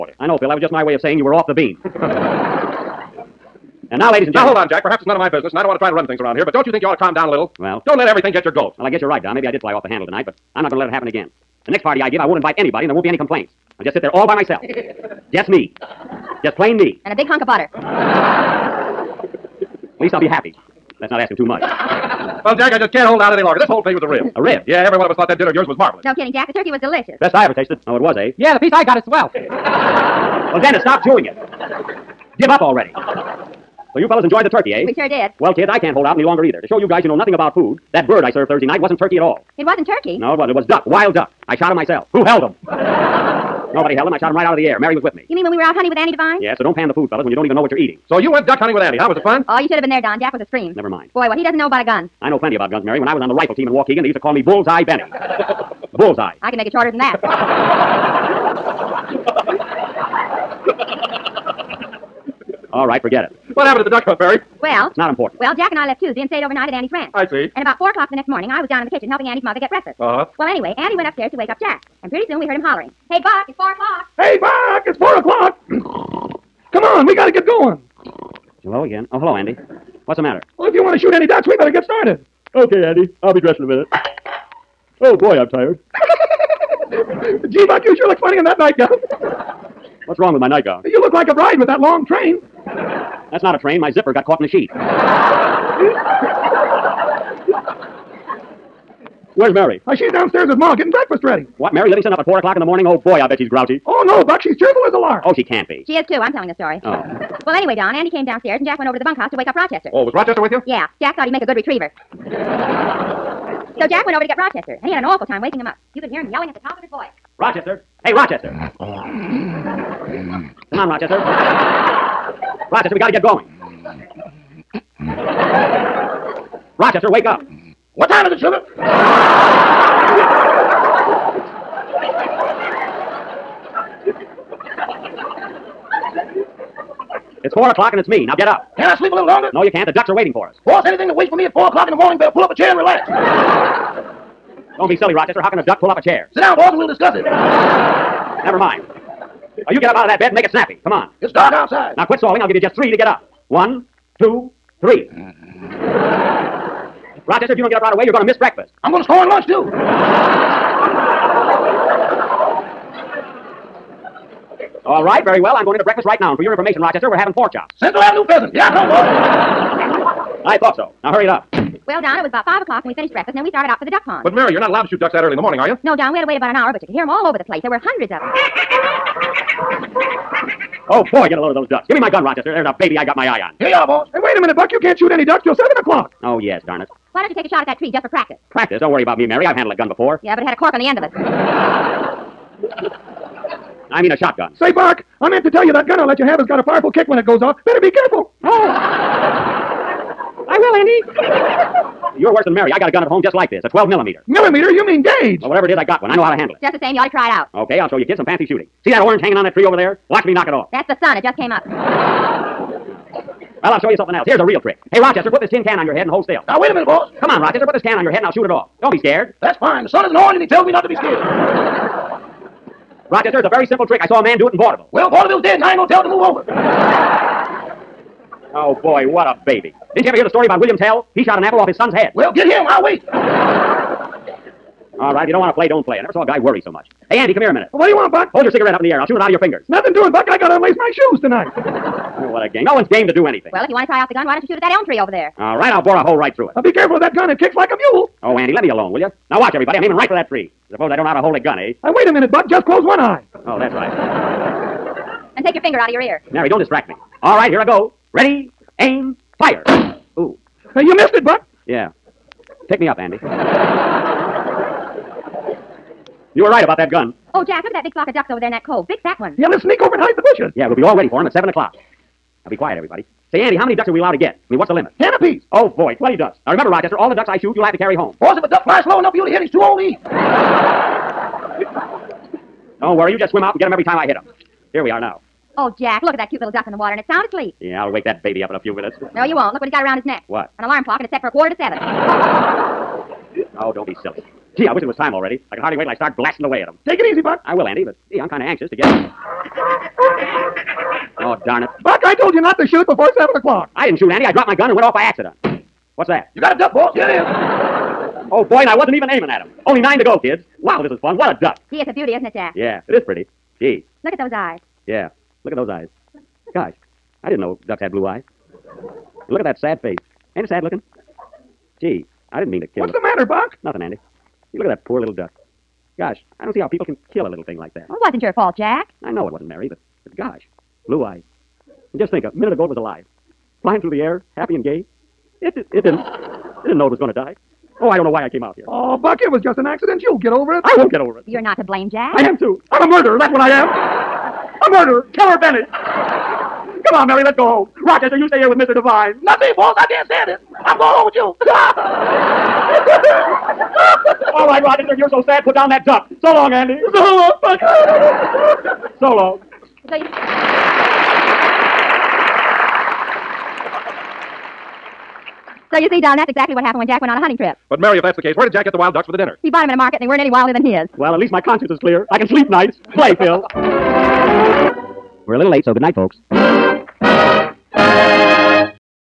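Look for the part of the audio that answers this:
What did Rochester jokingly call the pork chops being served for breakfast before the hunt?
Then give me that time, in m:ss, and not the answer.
2:47.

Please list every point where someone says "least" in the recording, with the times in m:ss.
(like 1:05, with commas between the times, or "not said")
0:20, 6:11.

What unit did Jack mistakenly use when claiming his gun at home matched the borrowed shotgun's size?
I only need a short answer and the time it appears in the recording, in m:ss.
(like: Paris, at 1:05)
millimeter, at 3:23.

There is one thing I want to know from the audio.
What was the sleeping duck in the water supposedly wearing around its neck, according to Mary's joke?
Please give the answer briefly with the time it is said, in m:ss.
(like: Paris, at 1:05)
An alarm clock, at 4:50.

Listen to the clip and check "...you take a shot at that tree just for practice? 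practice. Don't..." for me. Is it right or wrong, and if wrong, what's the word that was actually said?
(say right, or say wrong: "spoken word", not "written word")
right.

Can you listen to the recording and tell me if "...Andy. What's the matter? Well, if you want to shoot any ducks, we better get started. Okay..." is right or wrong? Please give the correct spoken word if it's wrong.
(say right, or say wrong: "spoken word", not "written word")
right.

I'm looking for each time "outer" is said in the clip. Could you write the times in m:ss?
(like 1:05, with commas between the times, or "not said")
not said.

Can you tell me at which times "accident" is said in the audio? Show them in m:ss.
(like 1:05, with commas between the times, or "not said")
5:05, 5:39.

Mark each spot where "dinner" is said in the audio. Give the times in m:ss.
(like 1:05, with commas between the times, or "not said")
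0:25, 6:09.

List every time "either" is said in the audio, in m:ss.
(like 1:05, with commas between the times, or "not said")
0:36.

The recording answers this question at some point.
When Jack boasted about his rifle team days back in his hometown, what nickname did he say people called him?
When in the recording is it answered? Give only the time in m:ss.
0:54.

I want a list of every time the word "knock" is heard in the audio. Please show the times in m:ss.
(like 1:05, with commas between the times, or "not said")
3:30.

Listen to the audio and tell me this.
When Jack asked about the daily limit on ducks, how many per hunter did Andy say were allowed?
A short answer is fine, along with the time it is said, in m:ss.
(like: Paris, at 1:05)
10, at 4:34.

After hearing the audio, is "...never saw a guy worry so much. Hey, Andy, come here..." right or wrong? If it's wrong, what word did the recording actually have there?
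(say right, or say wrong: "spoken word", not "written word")
right.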